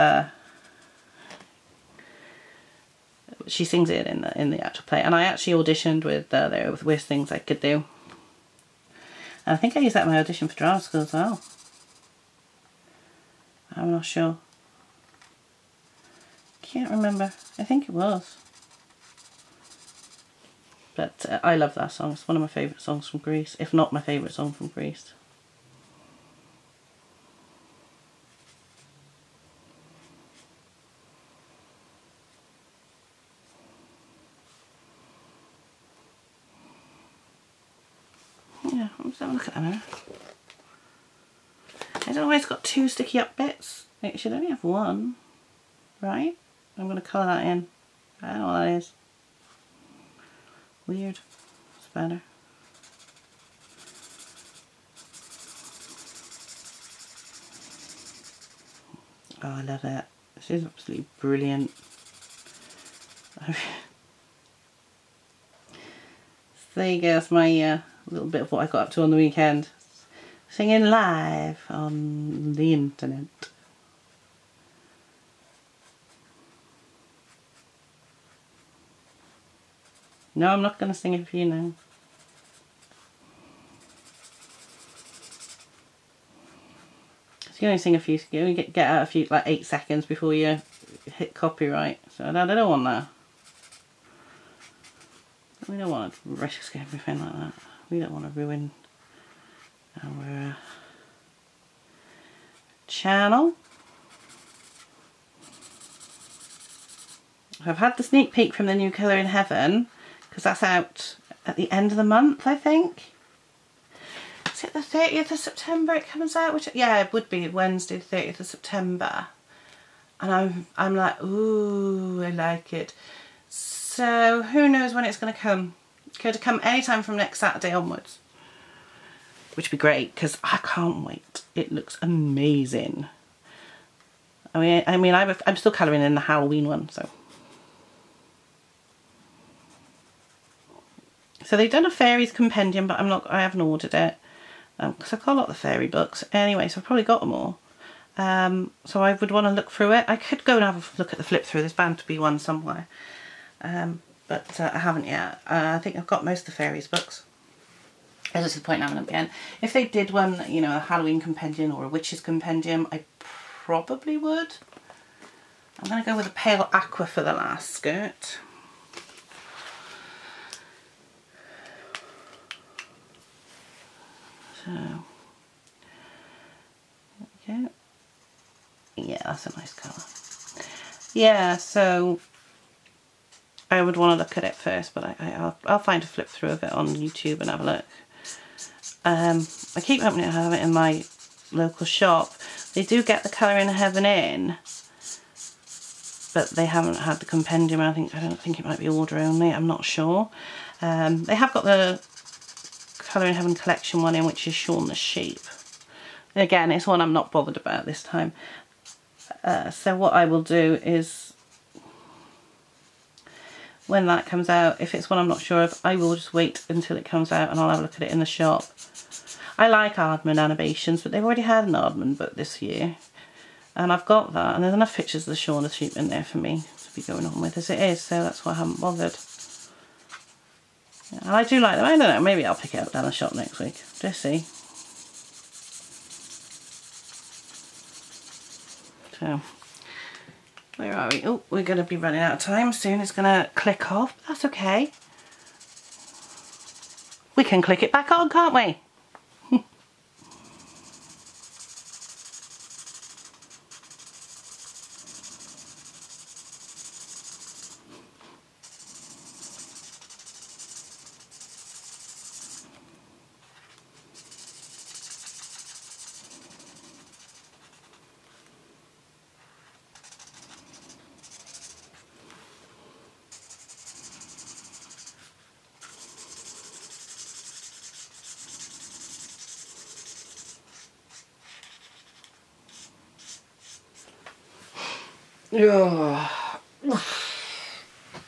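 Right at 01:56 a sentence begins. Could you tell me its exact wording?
Which Yeah it would be Wednesday the 30th of September and I'm, I'm like ooh I like it.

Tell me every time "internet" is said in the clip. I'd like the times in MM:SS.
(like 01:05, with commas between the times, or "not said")
01:12.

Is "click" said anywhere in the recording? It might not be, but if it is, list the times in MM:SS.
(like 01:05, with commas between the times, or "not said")
04:03, 04:07.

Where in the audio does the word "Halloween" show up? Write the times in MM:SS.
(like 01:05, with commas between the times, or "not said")
02:16, 02:40.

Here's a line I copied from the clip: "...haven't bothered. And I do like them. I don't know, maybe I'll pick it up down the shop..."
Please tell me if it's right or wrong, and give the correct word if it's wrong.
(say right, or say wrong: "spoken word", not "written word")
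right.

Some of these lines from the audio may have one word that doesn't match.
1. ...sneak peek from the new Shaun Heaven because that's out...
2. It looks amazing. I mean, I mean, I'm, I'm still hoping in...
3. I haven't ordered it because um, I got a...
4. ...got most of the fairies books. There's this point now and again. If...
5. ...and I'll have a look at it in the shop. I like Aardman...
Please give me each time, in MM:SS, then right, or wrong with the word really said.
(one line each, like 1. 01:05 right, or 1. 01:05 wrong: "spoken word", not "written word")
1. 01:48 wrong: "Colouring", not "Shaun"
2. 02:11 wrong: "colouring", not "hoping"
3. 02:23 right
4. 02:36 right
5. 03:37 right.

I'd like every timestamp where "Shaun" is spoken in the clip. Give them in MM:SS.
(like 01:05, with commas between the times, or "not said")
03:24, 03:45.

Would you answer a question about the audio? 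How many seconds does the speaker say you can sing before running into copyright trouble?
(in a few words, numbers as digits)
8 seconds.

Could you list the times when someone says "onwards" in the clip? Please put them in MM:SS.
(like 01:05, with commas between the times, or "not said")
02:07.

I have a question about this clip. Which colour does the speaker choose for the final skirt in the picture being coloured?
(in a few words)
Pale aqua.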